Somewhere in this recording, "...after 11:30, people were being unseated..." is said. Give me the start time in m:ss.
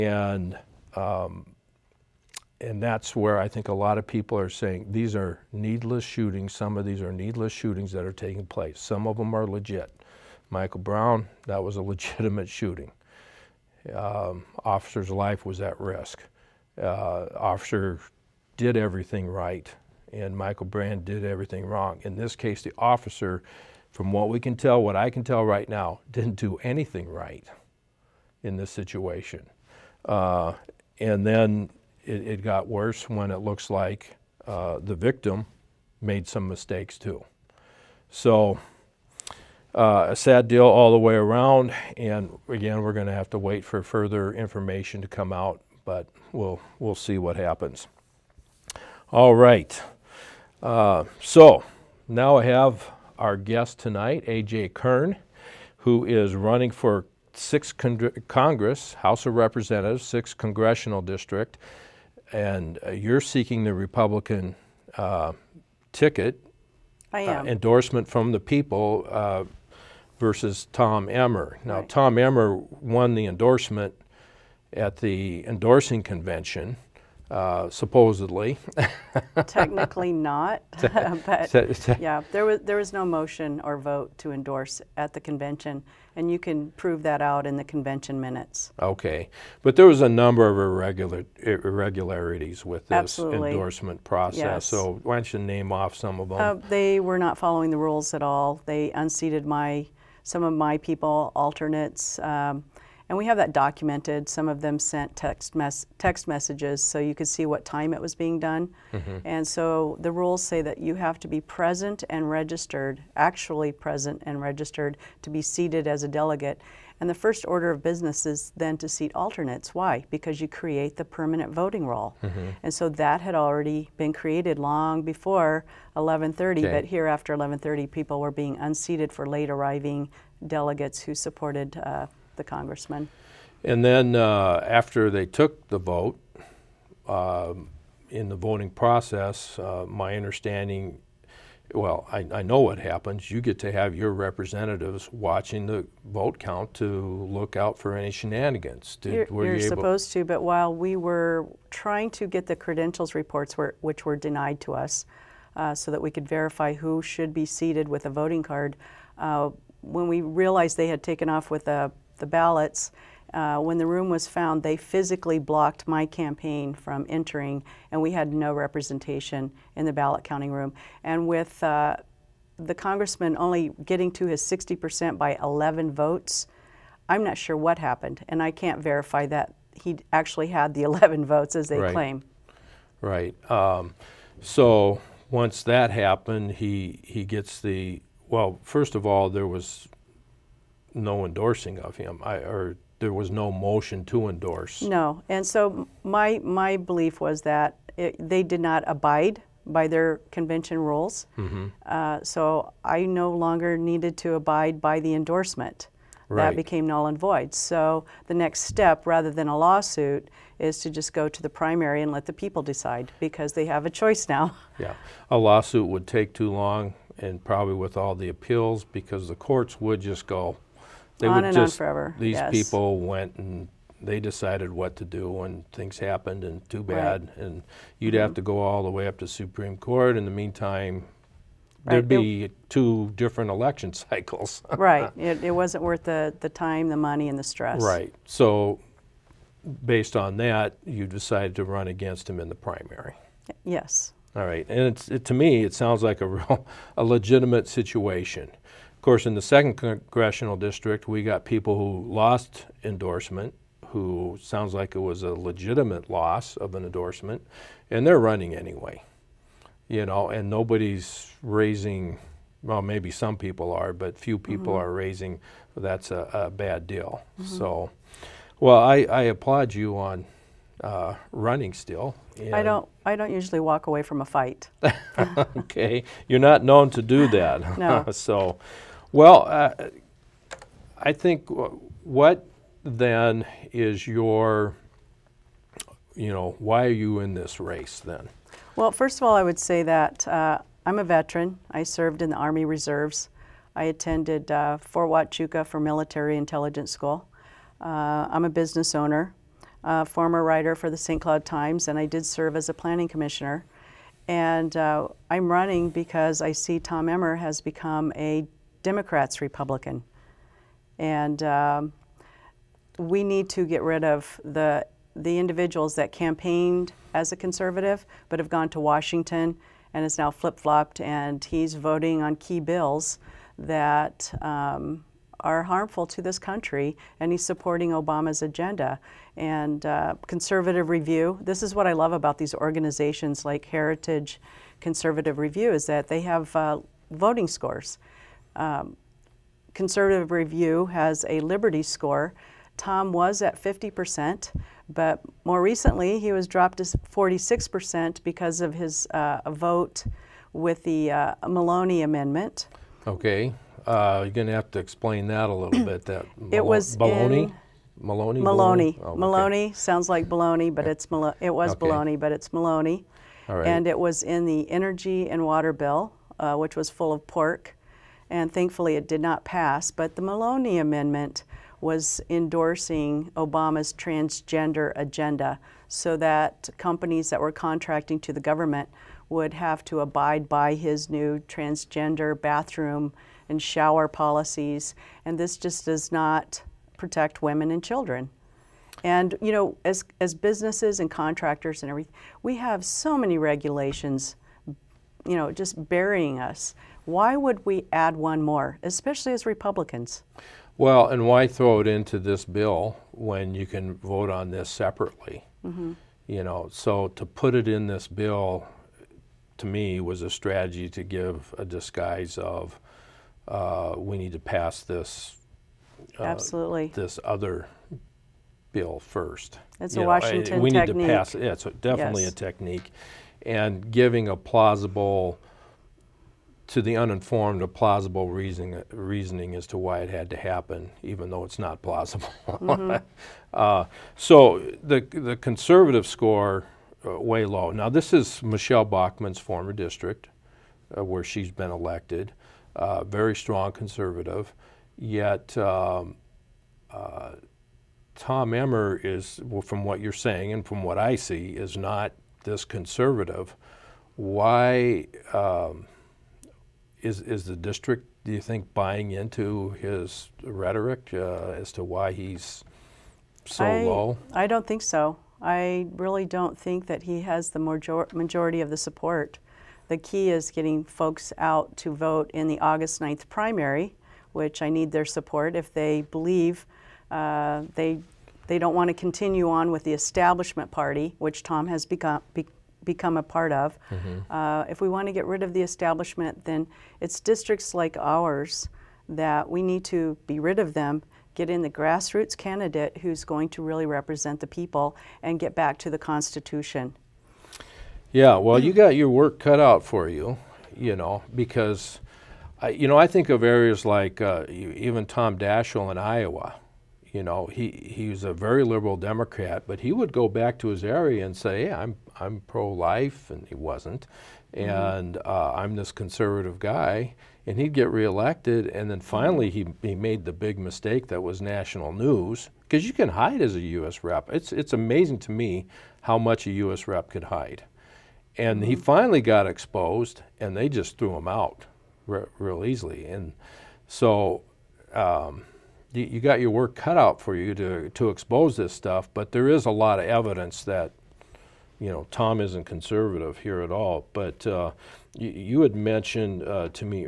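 2:07.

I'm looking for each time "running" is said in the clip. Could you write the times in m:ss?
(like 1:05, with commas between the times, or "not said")
0:56, 4:18, 4:31, 5:05.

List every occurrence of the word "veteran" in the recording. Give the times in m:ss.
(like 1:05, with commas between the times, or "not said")
4:51.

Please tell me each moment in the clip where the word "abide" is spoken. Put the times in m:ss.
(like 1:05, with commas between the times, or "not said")
3:18, 3:24, 6:20.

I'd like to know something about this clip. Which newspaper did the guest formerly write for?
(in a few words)
St. Cloud Times.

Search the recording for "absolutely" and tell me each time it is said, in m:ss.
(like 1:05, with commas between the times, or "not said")
1:32, 6:56.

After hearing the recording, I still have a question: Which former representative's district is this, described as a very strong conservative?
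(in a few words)
Michele Bachmann.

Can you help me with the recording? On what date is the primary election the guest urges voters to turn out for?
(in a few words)
August 9.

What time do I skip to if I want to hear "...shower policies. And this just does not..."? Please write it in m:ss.
6:23.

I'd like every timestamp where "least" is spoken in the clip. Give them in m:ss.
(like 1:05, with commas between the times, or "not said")
not said.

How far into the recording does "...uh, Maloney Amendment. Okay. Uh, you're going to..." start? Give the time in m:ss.
5:51.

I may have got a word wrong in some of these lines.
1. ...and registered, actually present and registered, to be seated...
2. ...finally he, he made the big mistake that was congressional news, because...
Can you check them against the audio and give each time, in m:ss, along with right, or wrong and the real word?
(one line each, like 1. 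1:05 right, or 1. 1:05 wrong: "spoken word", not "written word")
1. 1:52 right
2. 8:39 wrong: "national", not "congressional".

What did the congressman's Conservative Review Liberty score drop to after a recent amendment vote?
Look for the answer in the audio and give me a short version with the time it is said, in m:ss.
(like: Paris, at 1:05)
46%, at 5:46.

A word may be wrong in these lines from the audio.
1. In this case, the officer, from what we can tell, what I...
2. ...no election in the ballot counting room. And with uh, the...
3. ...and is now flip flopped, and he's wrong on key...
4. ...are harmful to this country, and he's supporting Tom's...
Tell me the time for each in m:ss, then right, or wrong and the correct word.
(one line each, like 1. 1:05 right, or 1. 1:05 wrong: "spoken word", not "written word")
1. 0:22 right
2. 2:48 wrong: "representation", not "election"
3. 5:19 wrong: "voting", not "wrong"
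4. 5:25 wrong: "Obama", not "Tom".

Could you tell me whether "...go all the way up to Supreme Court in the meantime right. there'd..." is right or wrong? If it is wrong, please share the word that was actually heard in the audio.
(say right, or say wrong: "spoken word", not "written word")
right.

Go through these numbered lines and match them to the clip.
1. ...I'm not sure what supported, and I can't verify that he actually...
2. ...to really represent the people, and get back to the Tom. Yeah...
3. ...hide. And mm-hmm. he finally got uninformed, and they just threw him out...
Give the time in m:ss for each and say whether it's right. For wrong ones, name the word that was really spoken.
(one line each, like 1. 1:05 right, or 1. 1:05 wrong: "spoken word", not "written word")
1. 2:57 wrong: "happened", not "supported"
2. 8:13 wrong: "Constitution", not "Tom"
3. 8:47 wrong: "exposed", not "uninformed".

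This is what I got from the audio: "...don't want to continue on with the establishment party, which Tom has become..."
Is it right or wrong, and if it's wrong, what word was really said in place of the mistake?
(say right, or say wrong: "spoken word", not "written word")
right.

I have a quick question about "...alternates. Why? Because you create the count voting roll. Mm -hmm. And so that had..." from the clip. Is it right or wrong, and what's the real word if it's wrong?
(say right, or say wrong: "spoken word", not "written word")
wrong: "permanent", not "count".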